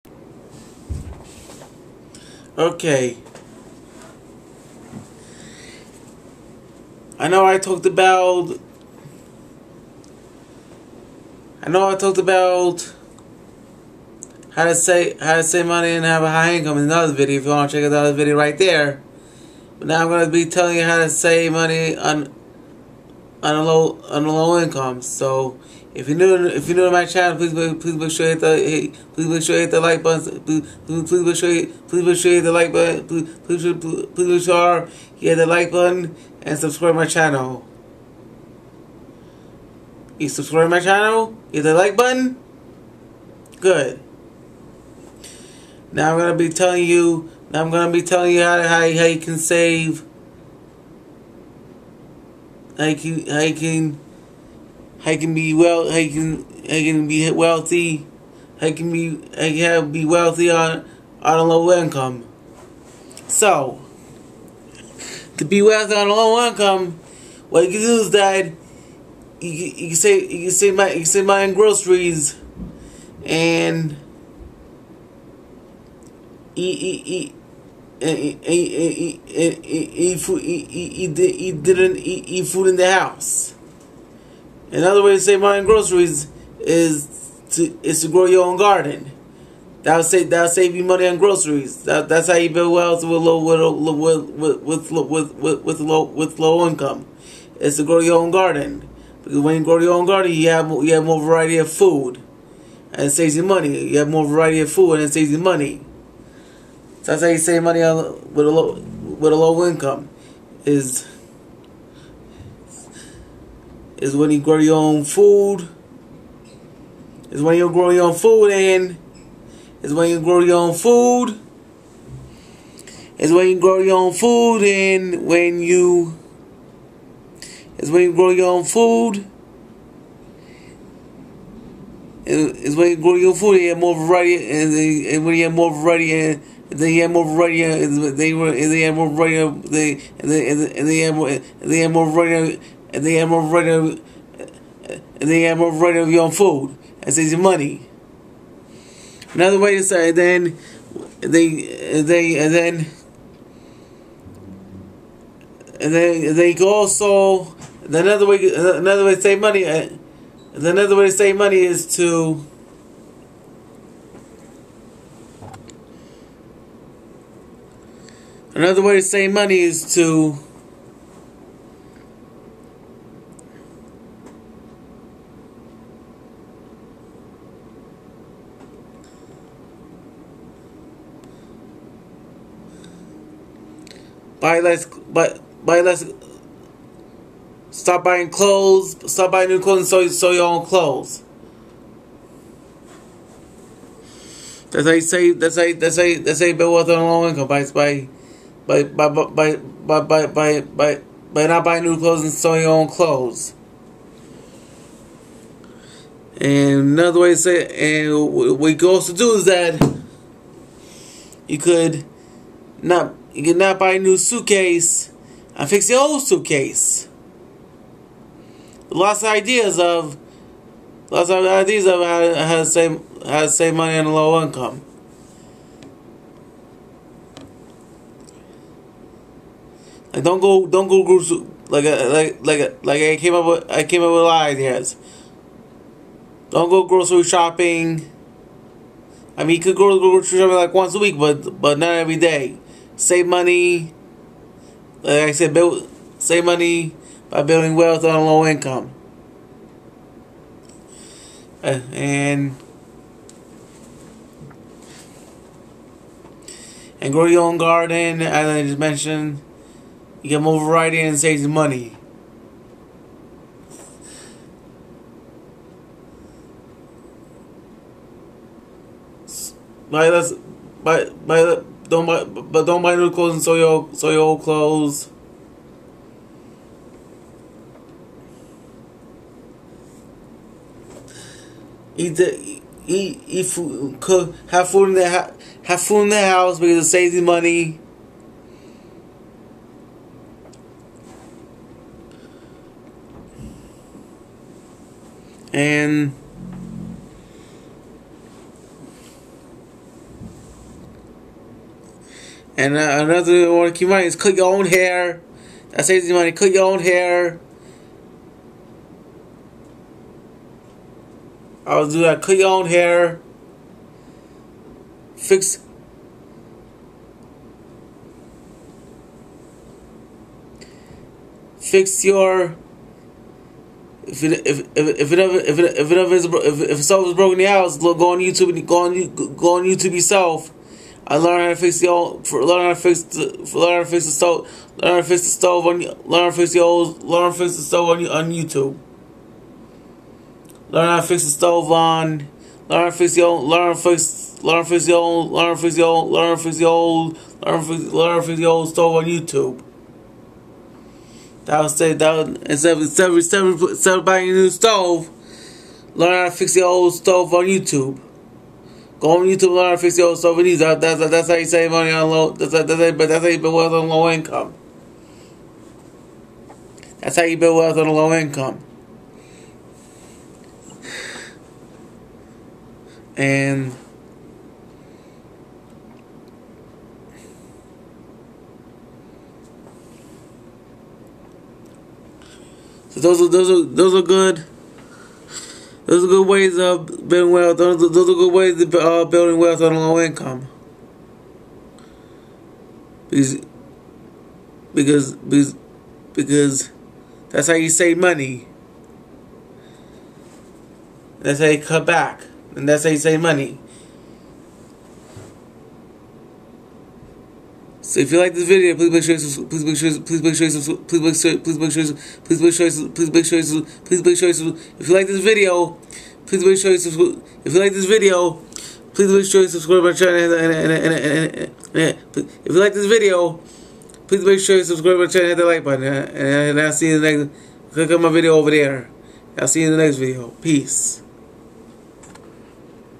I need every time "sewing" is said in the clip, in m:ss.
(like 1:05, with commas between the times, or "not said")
3:22.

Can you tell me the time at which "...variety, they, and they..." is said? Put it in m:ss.
2:19.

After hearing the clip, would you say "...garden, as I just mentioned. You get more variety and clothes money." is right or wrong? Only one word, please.
wrong.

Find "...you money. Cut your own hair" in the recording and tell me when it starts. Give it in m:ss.
5:06.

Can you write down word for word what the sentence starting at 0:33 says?
Please please please make sure you hit the like button and subscribe my channel.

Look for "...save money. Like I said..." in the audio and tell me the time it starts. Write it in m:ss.
4:02.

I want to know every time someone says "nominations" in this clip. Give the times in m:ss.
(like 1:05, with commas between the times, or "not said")
not said.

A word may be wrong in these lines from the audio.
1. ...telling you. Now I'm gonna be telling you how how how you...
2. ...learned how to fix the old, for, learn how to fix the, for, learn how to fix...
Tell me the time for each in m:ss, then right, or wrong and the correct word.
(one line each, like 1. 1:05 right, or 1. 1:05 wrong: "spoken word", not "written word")
1. 0:46 right
2. 5:31 right.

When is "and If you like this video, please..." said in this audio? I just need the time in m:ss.
7:00.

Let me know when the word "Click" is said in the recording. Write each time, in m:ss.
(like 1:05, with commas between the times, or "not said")
7:07.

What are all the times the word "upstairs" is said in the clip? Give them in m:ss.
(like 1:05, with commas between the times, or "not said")
not said.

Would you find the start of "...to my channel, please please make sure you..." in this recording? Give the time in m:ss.
0:26.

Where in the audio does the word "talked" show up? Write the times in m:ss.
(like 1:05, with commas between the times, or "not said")
0:07, 0:11.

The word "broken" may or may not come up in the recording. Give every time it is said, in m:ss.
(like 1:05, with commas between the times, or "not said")
5:27.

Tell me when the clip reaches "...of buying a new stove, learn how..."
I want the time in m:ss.
5:53.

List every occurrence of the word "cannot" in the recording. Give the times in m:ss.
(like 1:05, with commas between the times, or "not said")
3:33.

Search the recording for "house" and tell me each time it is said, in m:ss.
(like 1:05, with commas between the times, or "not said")
1:22, 4:46, 5:27.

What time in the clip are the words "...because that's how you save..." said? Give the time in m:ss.
6:36.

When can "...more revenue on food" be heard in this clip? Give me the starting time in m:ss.
2:25.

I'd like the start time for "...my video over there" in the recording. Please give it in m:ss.
7:08.